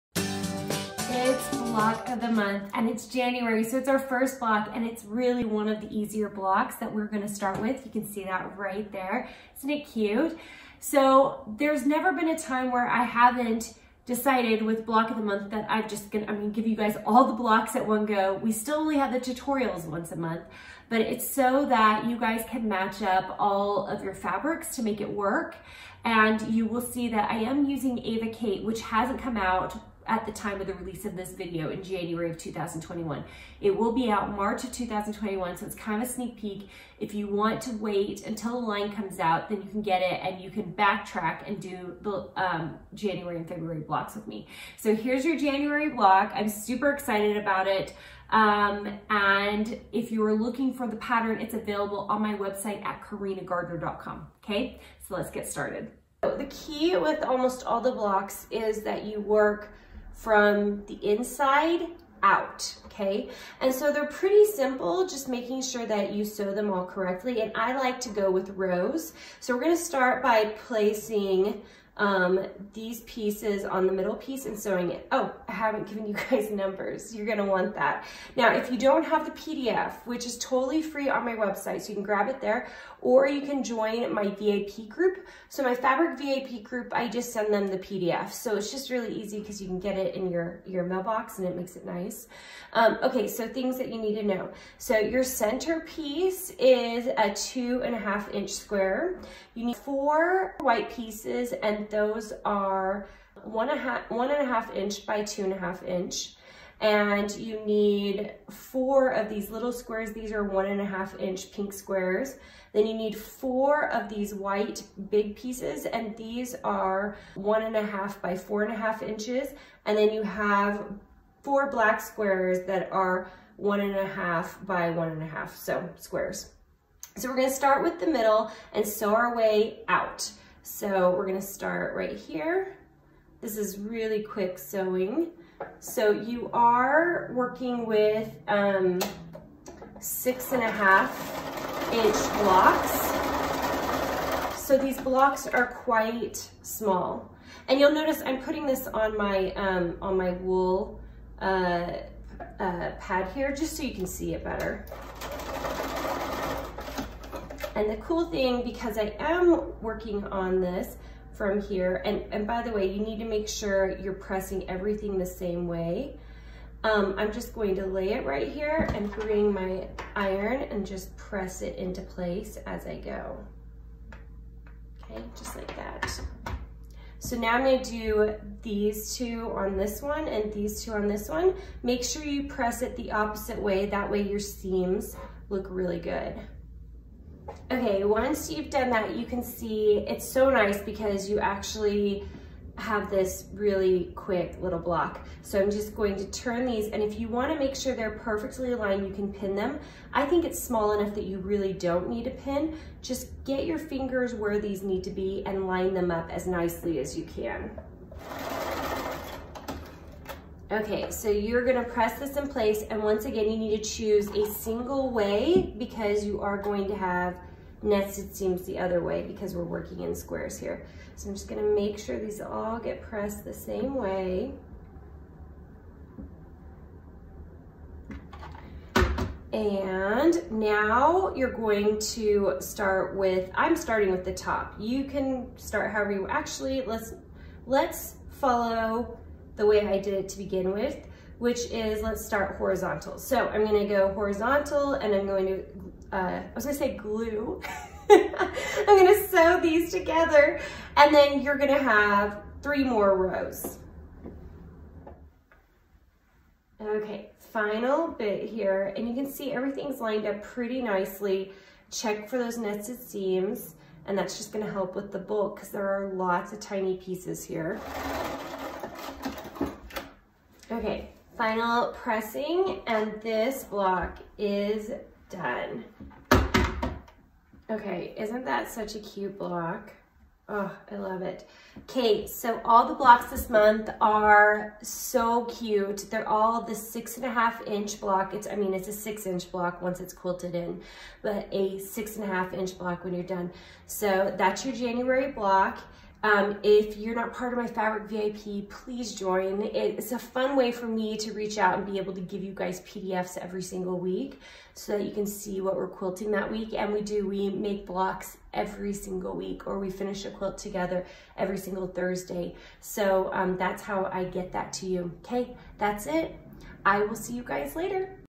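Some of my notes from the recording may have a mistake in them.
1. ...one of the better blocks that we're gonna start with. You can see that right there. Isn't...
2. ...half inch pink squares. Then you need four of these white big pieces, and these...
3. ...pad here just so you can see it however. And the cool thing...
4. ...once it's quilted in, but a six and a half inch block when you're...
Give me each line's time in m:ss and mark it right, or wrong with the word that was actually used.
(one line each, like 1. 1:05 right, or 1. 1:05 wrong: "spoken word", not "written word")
1. 0:05 wrong: "easier", not "better"
2. 1:50 right
3. 2:32 wrong: "better", not "however"
4. 4:49 right.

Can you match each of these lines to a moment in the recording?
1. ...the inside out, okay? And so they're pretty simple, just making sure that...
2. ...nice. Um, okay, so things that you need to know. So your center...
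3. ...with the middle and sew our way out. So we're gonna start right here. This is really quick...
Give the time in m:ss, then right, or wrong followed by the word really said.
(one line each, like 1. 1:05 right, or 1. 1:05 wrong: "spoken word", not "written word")
1. 1:00 right
2. 1:31 right
3. 2:07 right.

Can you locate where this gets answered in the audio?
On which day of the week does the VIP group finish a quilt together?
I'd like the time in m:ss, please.
5:11.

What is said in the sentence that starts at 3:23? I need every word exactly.
Just get your fingers where these need to be and line them up as nicely as you can.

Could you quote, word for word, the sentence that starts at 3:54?
You can start however you, actually, let's, let's follow the way I did it to begin with, which is let's start horizontal.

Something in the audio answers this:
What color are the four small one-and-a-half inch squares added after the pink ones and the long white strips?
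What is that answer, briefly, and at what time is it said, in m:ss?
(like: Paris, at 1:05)
black, at 2:01.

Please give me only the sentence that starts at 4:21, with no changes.
Check for those nested seams, and that's just gonna help with the bulk because there are lots of tiny pieces here.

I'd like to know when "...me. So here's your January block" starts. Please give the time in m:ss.
0:44.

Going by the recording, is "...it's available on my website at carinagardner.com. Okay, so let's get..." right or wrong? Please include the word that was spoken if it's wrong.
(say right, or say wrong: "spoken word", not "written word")
right.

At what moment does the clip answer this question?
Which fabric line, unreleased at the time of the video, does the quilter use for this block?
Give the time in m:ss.
0:27.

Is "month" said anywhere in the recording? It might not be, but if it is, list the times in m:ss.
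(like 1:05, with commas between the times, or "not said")
0:02, 0:15, 0:20, 4:43.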